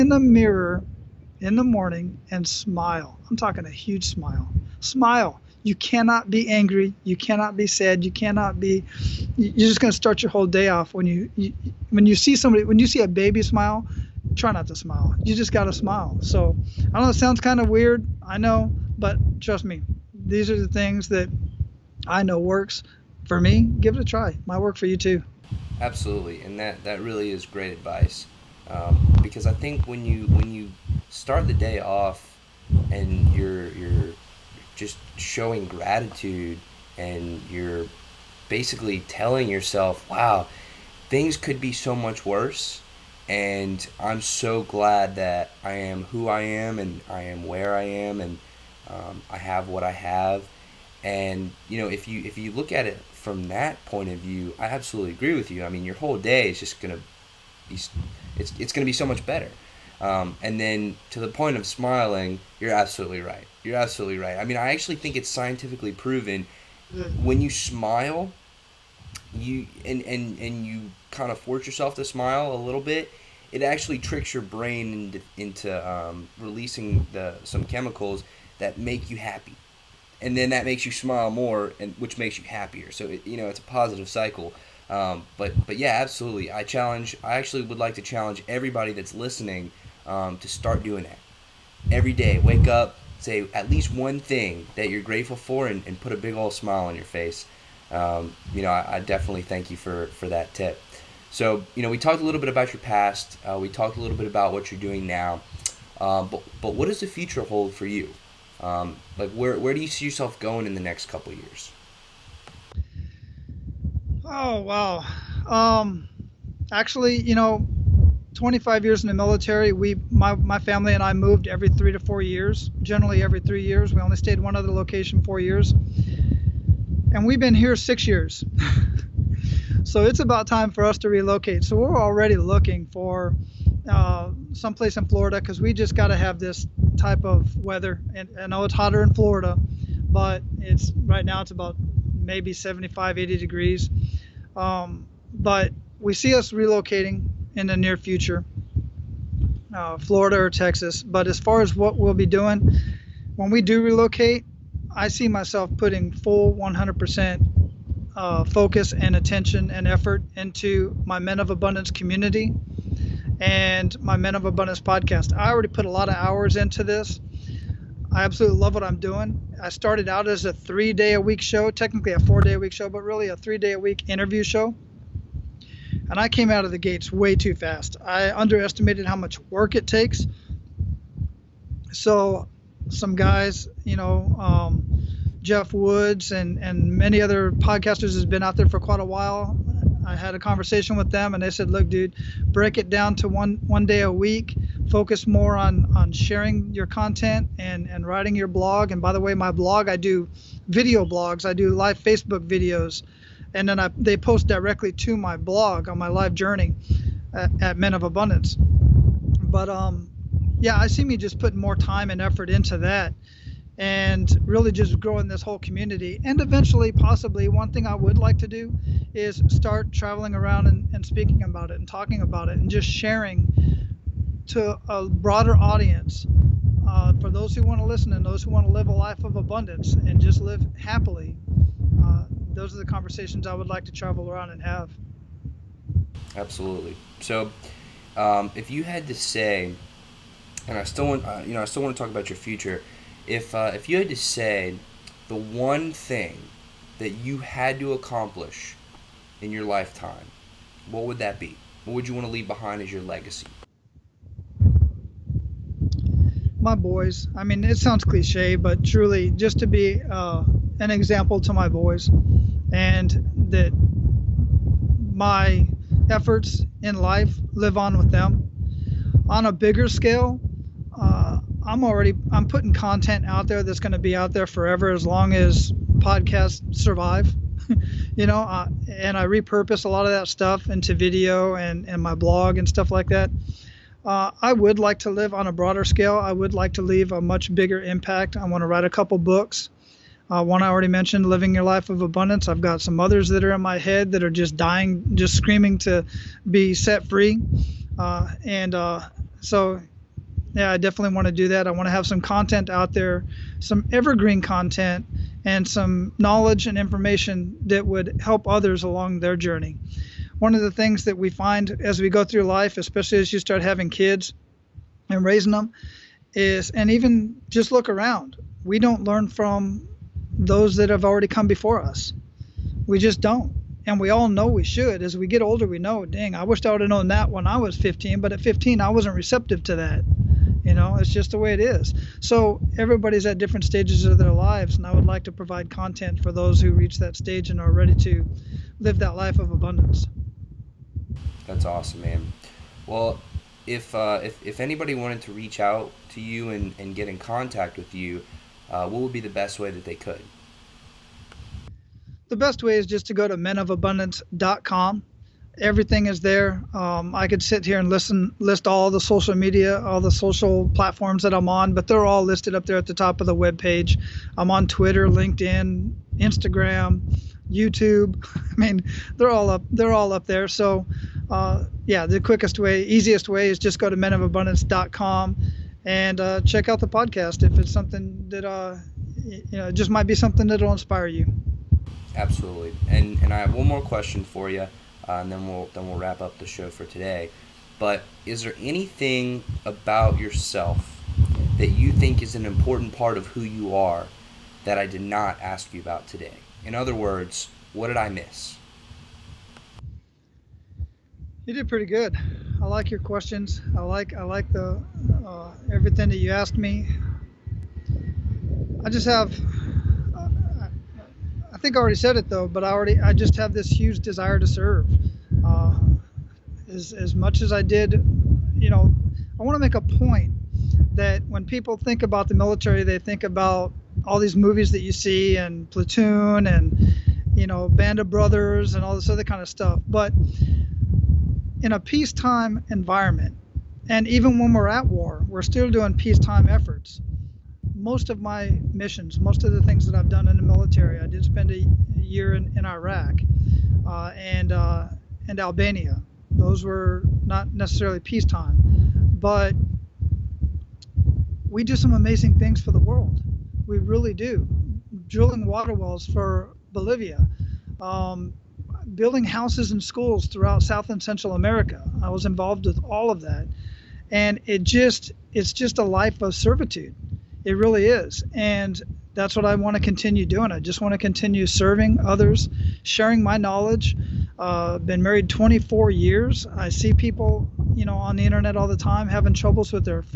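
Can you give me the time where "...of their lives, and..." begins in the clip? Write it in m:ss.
5:34.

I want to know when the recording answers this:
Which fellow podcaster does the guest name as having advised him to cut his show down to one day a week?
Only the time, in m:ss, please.
3:05.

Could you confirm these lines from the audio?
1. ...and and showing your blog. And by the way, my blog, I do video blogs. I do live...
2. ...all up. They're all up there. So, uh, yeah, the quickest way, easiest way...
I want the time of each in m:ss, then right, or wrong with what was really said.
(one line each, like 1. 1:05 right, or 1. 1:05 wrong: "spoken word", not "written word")
1. 3:17 wrong: "writing", not "showing"
2. 6:09 right.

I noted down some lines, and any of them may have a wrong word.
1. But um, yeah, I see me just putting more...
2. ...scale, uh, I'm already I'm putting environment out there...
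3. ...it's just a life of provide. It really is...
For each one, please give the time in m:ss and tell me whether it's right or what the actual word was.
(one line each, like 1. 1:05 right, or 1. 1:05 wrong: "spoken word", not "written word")
1. 3:28 right
2. 4:29 wrong: "content", not "environment"
3. 7:45 wrong: "servitude", not "provide".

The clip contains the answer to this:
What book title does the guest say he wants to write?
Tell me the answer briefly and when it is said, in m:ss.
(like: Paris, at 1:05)
Living Your Life of Abundance, at 4:51.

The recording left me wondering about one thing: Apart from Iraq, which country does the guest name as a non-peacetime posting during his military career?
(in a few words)
Albania.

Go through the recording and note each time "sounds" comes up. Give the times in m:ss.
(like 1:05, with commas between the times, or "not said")
0:17, 4:17.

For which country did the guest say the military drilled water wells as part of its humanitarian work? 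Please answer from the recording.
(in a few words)
Bolivia.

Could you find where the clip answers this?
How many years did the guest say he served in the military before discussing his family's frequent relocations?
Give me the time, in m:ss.
1:58.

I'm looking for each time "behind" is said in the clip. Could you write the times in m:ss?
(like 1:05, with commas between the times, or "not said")
4:12.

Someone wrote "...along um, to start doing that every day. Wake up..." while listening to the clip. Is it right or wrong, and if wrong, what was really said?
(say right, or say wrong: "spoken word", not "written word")
wrong: "listening", not "along".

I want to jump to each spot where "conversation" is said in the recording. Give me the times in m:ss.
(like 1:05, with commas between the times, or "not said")
3:10, 3:52.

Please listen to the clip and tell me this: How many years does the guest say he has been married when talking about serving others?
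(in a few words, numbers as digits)
24.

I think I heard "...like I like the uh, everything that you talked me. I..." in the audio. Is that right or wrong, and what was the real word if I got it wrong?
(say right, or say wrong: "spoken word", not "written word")
wrong: "asked", not "talked".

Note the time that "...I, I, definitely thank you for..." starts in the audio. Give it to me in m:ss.
1:38.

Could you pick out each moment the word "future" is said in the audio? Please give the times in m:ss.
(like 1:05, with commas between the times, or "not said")
1:47, 2:27, 4:02.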